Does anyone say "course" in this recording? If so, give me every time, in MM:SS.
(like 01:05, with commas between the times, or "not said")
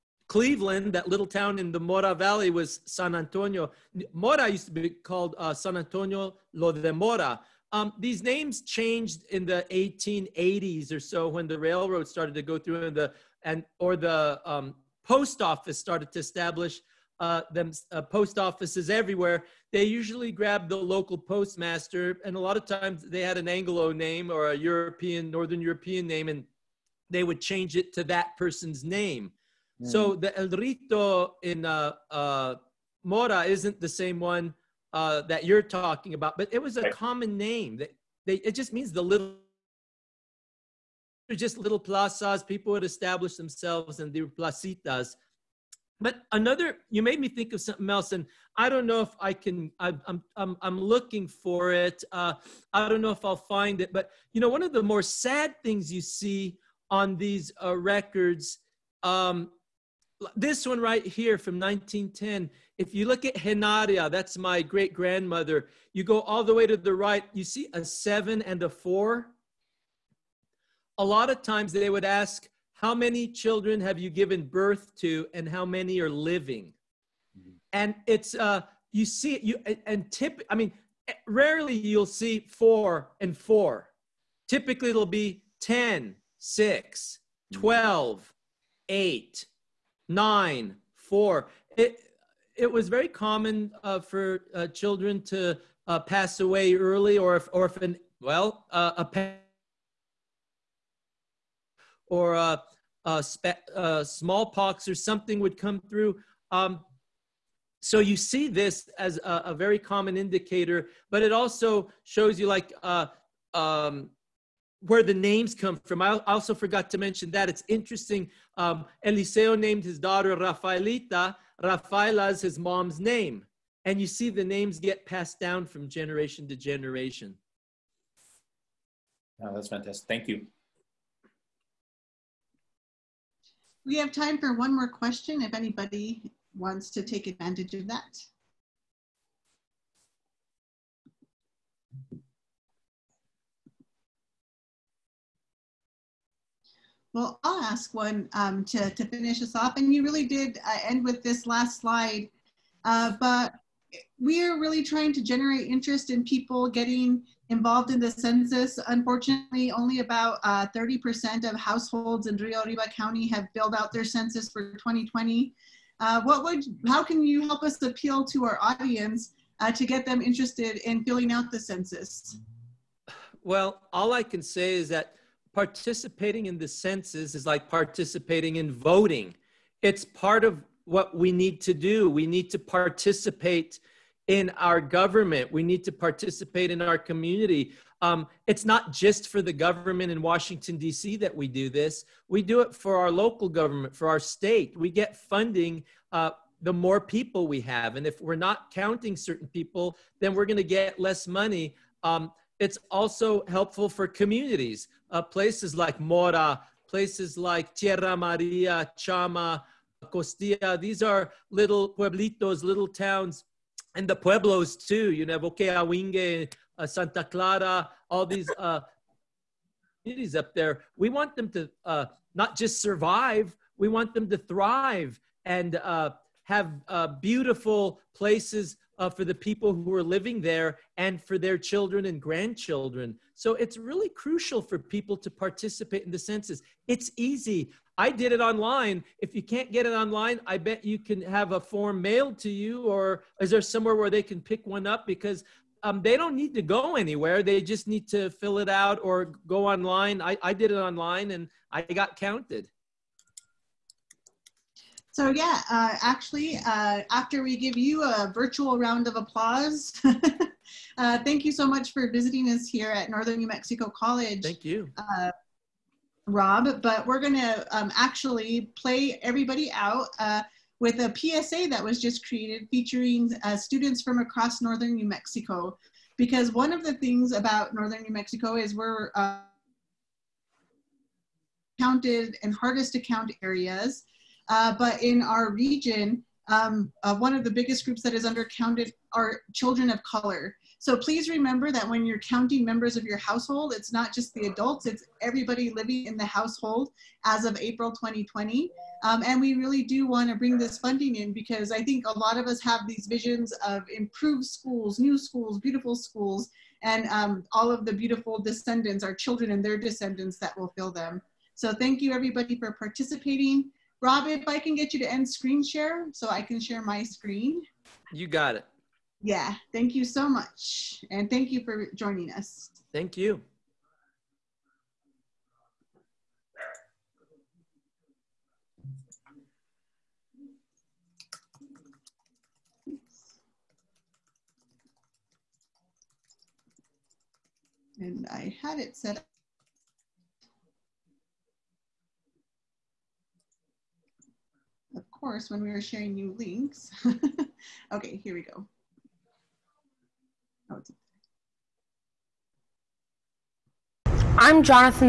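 05:45.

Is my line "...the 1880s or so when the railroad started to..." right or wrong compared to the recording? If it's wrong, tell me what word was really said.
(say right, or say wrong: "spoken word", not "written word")
right.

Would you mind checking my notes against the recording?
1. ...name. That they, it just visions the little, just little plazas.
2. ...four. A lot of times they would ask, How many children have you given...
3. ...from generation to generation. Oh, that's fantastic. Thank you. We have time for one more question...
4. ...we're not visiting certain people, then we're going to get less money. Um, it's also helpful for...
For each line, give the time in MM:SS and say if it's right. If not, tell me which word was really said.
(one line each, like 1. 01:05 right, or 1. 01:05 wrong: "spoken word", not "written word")
1. 00:37 wrong: "means", not "visions"
2. 01:08 right
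3. 02:05 right
4. 03:18 wrong: "counting", not "visiting".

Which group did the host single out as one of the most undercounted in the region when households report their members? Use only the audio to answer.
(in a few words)
Children of color.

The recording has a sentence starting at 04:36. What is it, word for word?
Because one of the things about Northern New Mexico is we're counted and hardest to count areas.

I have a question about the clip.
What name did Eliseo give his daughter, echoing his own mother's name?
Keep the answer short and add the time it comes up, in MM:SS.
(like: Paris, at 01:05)
Rafaelita, at 02:00.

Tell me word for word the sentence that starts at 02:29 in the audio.
And you really did uh, end with this last slide.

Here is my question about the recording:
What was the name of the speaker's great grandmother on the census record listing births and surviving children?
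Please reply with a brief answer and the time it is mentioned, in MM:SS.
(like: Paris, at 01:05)
Genaria, at 01:03.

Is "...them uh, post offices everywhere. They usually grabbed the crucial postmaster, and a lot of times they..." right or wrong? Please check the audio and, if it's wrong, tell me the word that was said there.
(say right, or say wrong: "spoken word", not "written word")
wrong: "local", not "crucial".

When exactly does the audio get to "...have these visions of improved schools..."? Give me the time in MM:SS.
05:02.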